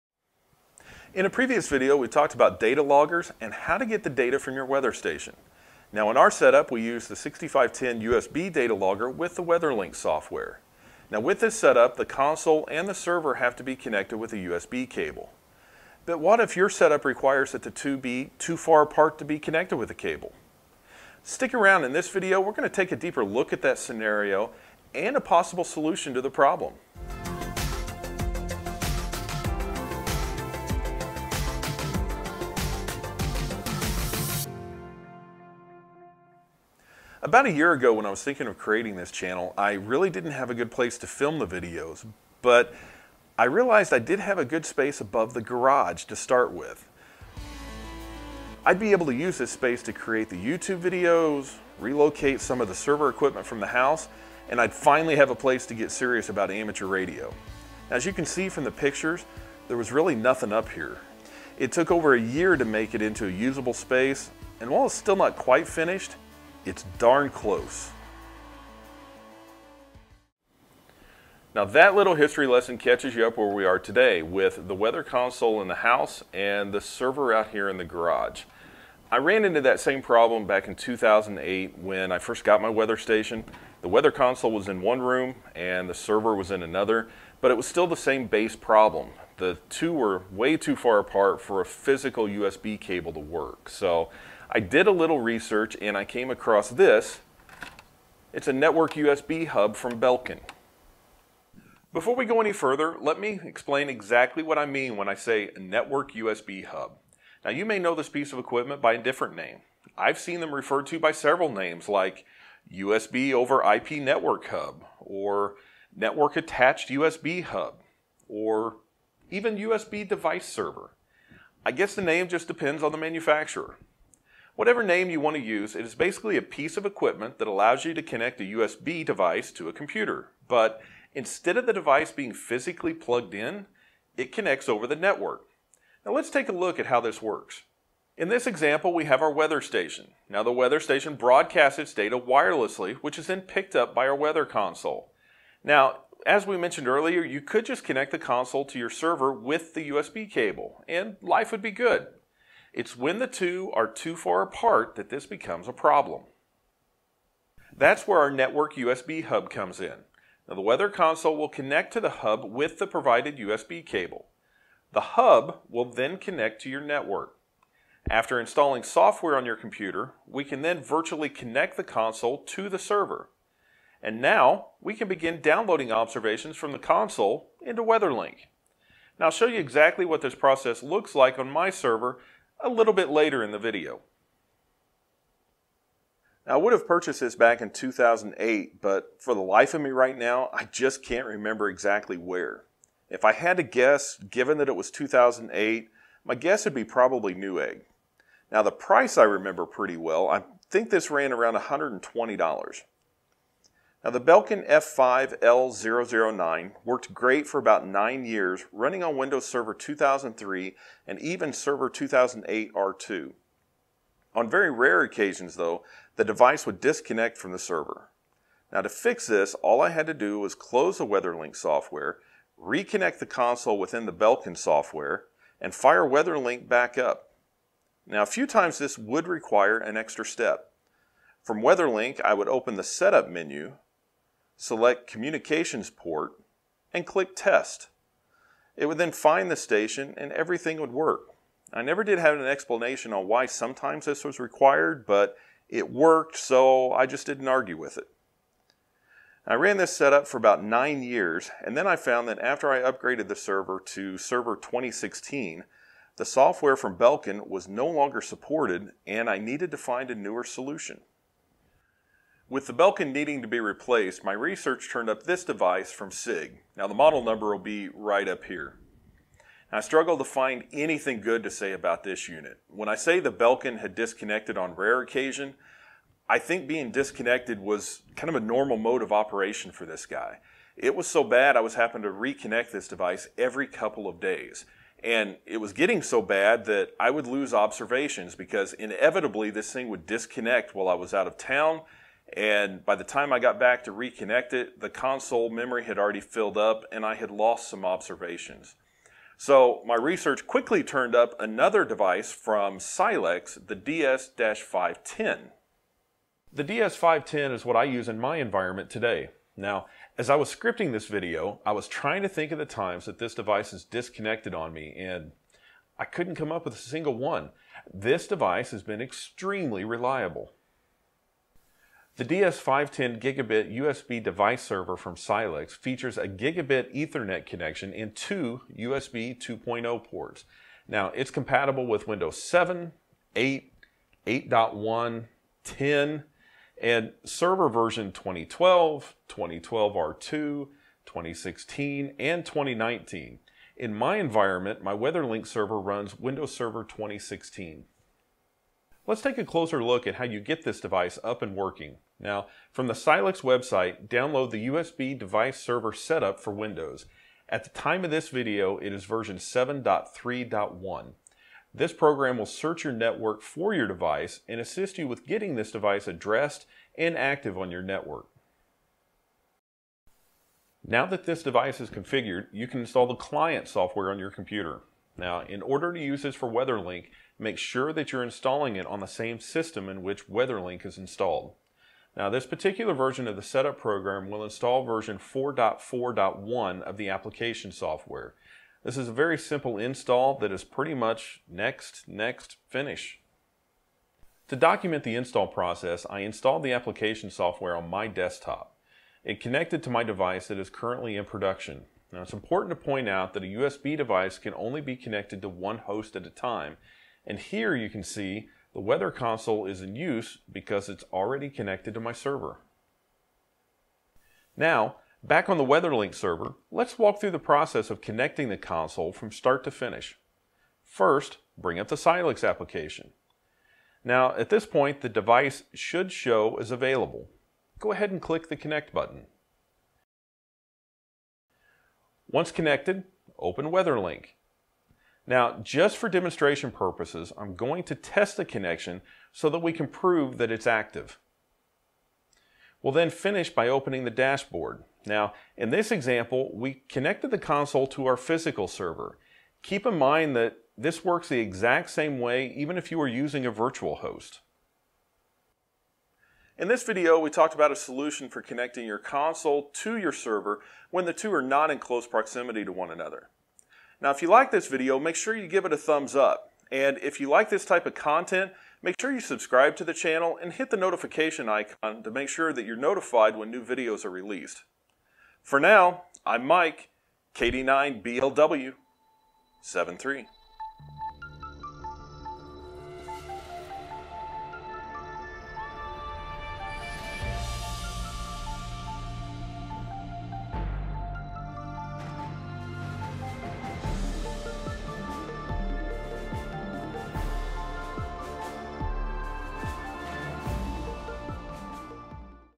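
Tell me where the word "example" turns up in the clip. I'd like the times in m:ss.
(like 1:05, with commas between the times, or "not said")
2:18, 7:25.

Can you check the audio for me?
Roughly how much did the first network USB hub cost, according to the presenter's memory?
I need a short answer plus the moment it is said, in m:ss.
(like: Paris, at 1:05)
$120, at 3:21.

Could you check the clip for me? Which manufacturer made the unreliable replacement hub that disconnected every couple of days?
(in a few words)
SIIG.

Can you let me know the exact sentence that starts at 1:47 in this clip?
Now you may know this piece of equipment by a different name.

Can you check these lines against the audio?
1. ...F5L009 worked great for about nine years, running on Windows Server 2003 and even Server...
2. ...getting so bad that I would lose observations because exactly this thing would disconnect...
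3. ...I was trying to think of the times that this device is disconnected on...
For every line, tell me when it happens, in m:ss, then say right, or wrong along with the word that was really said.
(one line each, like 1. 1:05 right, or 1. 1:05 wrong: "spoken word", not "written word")
1. 3:24 right
2. 4:45 wrong: "inevitably", not "exactly"
3. 5:11 right.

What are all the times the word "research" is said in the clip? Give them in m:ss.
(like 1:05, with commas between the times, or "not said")
1:35, 4:24, 4:59.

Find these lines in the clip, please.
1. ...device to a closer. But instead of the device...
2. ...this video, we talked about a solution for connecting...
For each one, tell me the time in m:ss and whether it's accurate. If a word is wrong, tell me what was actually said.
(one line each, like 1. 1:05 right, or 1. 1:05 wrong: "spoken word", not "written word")
1. 2:09 wrong: "computer", not "closer"
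2. 7:36 right.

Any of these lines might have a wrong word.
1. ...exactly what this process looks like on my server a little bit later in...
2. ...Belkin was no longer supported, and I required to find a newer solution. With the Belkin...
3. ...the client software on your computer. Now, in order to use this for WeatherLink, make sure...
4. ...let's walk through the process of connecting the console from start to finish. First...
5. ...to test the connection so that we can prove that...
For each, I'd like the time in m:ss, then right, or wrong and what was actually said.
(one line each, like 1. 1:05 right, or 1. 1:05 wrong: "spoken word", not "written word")
1. 2:59 right
2. 4:16 wrong: "needed", not "required"
3. 6:13 right
4. 6:56 right
5. 7:17 right.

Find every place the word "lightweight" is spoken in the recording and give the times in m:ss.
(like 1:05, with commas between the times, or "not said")
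not said.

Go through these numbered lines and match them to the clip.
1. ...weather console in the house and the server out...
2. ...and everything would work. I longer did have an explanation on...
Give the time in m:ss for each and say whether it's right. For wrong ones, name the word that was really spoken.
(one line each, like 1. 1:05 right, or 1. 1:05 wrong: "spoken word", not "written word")
1. 1:14 right
2. 4:00 wrong: "never", not "longer".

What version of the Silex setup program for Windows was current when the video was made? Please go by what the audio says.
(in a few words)
7.3.1.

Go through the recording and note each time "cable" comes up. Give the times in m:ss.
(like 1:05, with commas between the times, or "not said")
0:14, 0:19, 1:32, 2:30, 2:43.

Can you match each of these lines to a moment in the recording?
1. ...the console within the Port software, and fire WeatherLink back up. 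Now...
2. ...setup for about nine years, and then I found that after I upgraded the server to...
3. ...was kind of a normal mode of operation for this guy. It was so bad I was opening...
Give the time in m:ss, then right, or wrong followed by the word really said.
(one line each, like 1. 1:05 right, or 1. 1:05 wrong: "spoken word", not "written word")
1. 3:43 wrong: "Belkin", not "Port"
2. 4:09 right
3. 4:37 wrong: "having", not "opening".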